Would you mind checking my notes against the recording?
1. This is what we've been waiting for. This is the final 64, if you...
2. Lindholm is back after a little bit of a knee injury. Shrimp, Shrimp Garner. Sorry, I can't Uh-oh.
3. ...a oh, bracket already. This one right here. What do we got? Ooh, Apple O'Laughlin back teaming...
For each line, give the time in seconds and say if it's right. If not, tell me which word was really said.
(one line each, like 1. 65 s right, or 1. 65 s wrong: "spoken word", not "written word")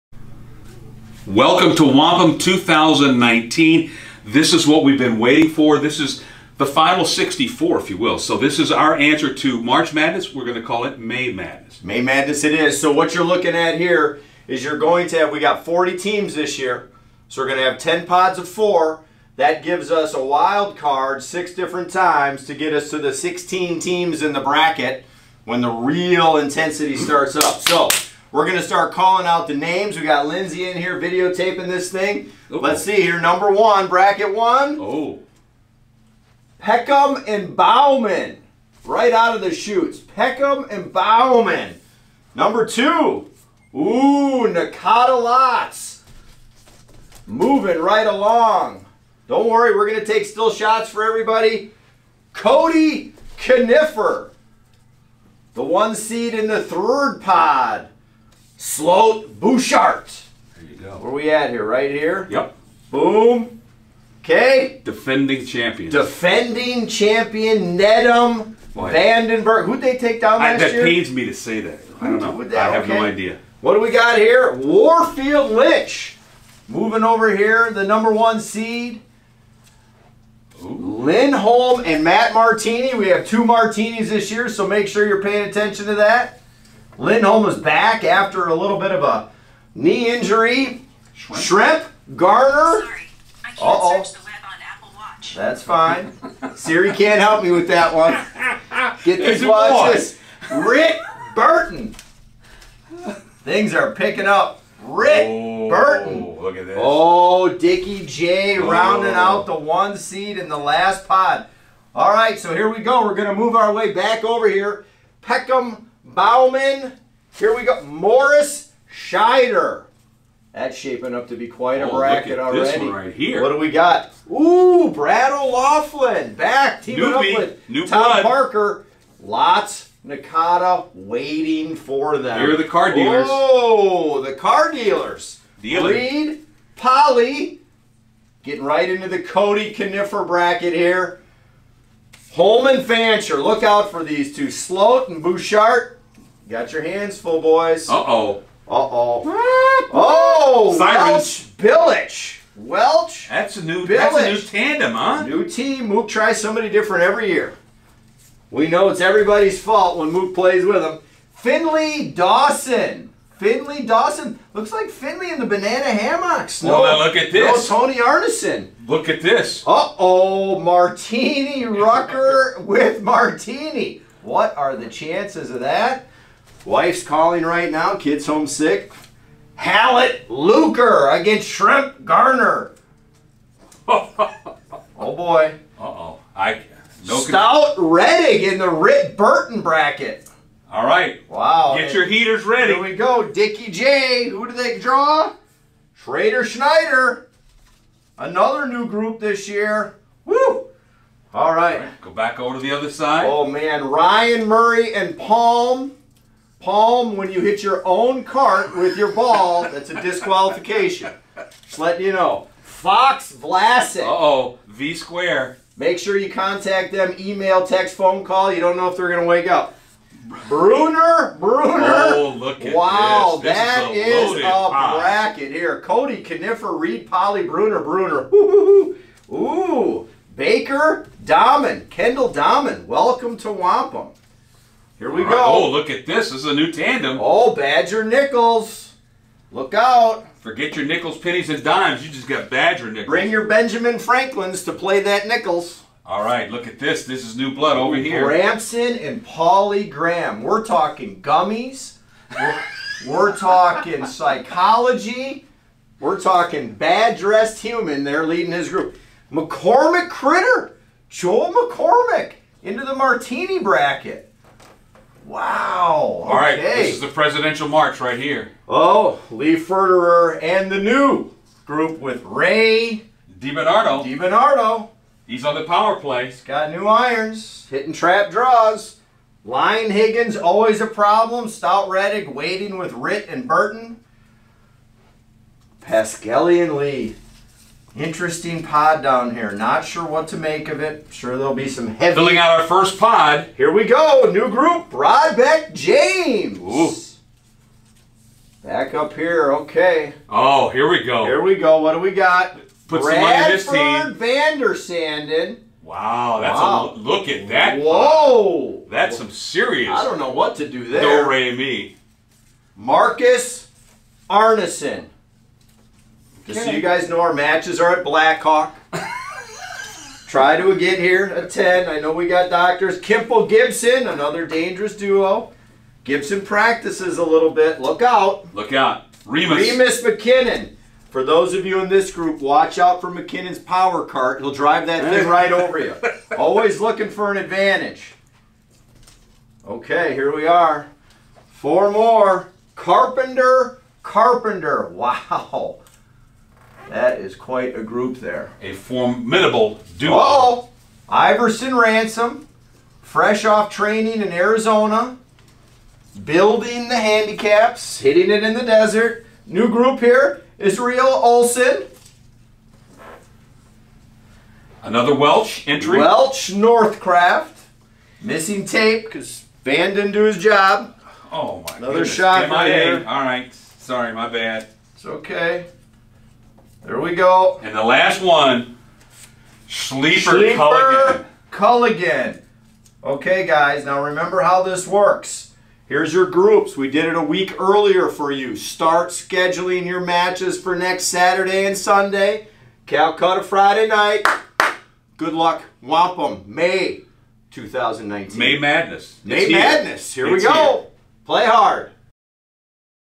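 1. 4 s right
2. 86 s right
3. 121 s wrong: "Brad", not "Apple".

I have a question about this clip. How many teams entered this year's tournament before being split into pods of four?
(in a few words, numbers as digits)
40.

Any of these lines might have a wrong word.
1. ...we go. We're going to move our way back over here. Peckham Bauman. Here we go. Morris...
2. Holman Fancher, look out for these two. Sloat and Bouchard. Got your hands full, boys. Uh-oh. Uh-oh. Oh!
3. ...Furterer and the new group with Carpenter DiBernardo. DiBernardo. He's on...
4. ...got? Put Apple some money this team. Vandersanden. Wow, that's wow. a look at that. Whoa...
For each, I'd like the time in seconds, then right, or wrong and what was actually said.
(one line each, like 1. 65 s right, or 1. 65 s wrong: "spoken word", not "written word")
1. 112 s right
2. 142 s right
3. 269 s wrong: "Ray", not "Carpenter"
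4. 302 s wrong: "Bradford", not "Apple".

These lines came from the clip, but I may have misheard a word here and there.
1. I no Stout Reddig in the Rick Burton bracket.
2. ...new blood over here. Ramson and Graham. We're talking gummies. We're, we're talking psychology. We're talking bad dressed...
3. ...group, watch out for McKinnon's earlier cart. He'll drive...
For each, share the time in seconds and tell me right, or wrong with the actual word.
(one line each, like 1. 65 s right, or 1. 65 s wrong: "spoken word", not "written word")
1. 186 s right
2. 247 s right
3. 332 s wrong: "power", not "earlier".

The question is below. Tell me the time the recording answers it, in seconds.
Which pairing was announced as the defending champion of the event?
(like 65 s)
67 s.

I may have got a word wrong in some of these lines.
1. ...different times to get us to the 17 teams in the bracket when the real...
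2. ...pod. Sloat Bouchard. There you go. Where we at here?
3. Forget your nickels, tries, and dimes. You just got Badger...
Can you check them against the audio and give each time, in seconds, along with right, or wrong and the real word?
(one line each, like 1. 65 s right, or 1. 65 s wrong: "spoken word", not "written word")
1. 21 s wrong: "16", not "17"
2. 57 s right
3. 240 s wrong: "pennies", not "tries".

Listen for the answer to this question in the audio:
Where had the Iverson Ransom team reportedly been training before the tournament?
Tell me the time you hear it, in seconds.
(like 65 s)
354 s.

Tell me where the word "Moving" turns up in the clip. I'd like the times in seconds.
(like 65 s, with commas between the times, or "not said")
47 s, 76 s.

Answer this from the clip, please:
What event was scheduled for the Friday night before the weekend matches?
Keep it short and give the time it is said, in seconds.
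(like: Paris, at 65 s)
Calcutta, at 392 s.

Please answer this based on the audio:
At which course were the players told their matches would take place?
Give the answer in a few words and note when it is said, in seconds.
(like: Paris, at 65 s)
Blackhawk, at 318 s.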